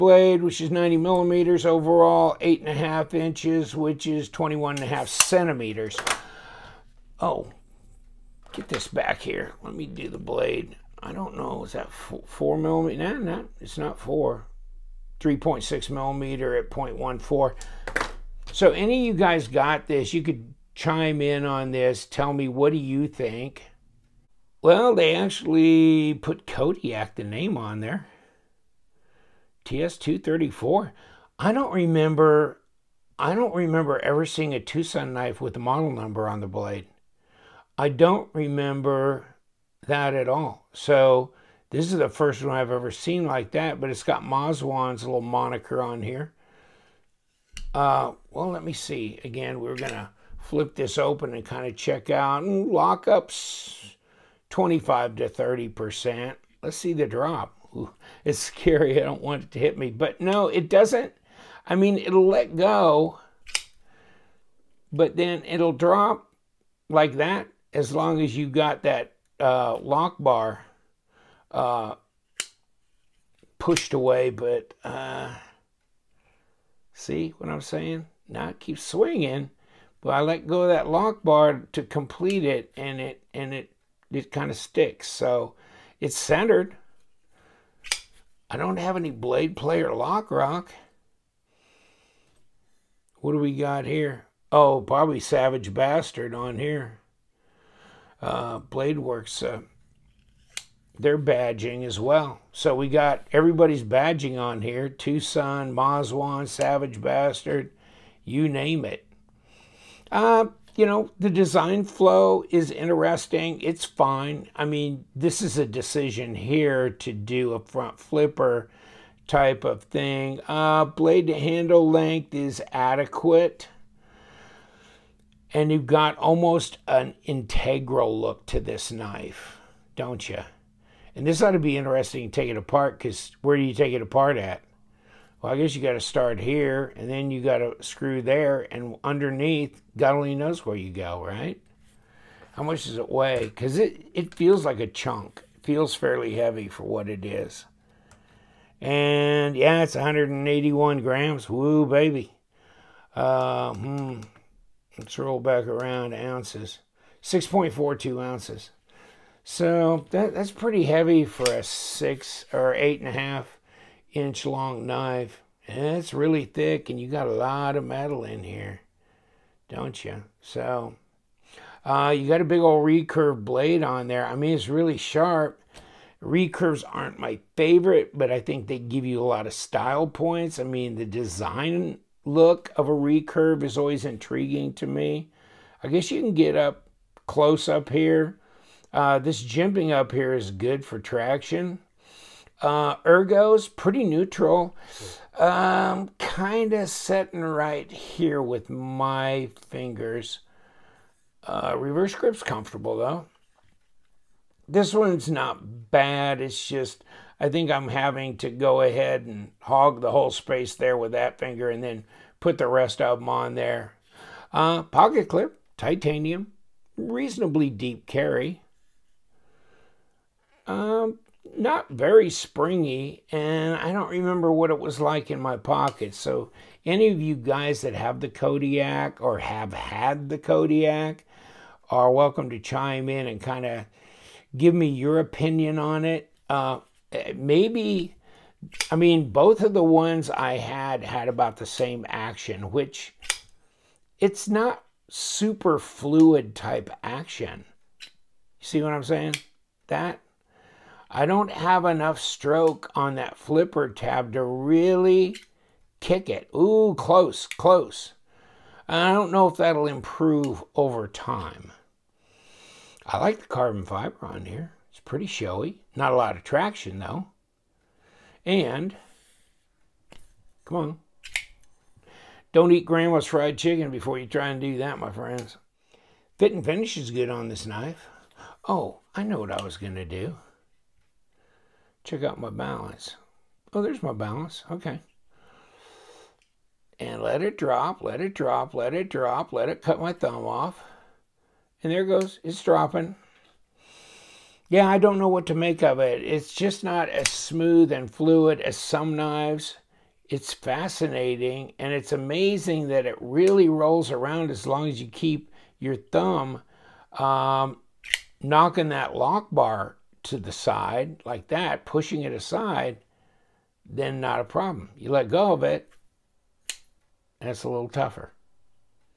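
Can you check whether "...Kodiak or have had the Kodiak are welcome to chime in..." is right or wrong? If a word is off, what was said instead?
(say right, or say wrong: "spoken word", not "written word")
right.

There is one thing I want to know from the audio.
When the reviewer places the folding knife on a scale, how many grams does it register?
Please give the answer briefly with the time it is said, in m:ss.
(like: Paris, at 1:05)
181 grams, at 2:29.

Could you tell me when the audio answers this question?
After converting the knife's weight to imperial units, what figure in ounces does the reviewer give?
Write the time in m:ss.
2:37.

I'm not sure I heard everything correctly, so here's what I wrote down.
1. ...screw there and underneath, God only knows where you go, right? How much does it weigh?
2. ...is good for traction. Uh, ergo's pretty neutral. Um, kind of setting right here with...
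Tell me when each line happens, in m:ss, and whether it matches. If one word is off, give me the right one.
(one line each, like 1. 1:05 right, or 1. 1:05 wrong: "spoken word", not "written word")
1. 2:17 right
2. 3:10 right.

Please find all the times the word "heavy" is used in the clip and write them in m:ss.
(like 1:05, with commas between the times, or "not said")
2:26, 2:40.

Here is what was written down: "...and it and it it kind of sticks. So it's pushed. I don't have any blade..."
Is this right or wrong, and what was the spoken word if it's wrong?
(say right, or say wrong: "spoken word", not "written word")
wrong: "centered", not "pushed".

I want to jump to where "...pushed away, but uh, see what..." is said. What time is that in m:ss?
1:13.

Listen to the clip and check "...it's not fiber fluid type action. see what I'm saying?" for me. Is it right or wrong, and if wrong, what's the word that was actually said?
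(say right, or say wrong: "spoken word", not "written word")
wrong: "super", not "fiber".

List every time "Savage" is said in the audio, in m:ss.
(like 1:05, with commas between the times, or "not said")
1:35, 1:46.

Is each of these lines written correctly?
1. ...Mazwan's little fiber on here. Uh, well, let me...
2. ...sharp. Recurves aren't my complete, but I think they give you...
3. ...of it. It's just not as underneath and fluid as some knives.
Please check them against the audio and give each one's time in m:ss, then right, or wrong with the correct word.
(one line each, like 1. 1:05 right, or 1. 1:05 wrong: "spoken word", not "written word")
1. 0:44 wrong: "moniker", not "fiber"
2. 2:54 wrong: "favorite", not "complete"
3. 4:55 wrong: "smooth", not "underneath".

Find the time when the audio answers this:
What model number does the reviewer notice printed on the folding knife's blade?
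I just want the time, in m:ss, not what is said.
0:29.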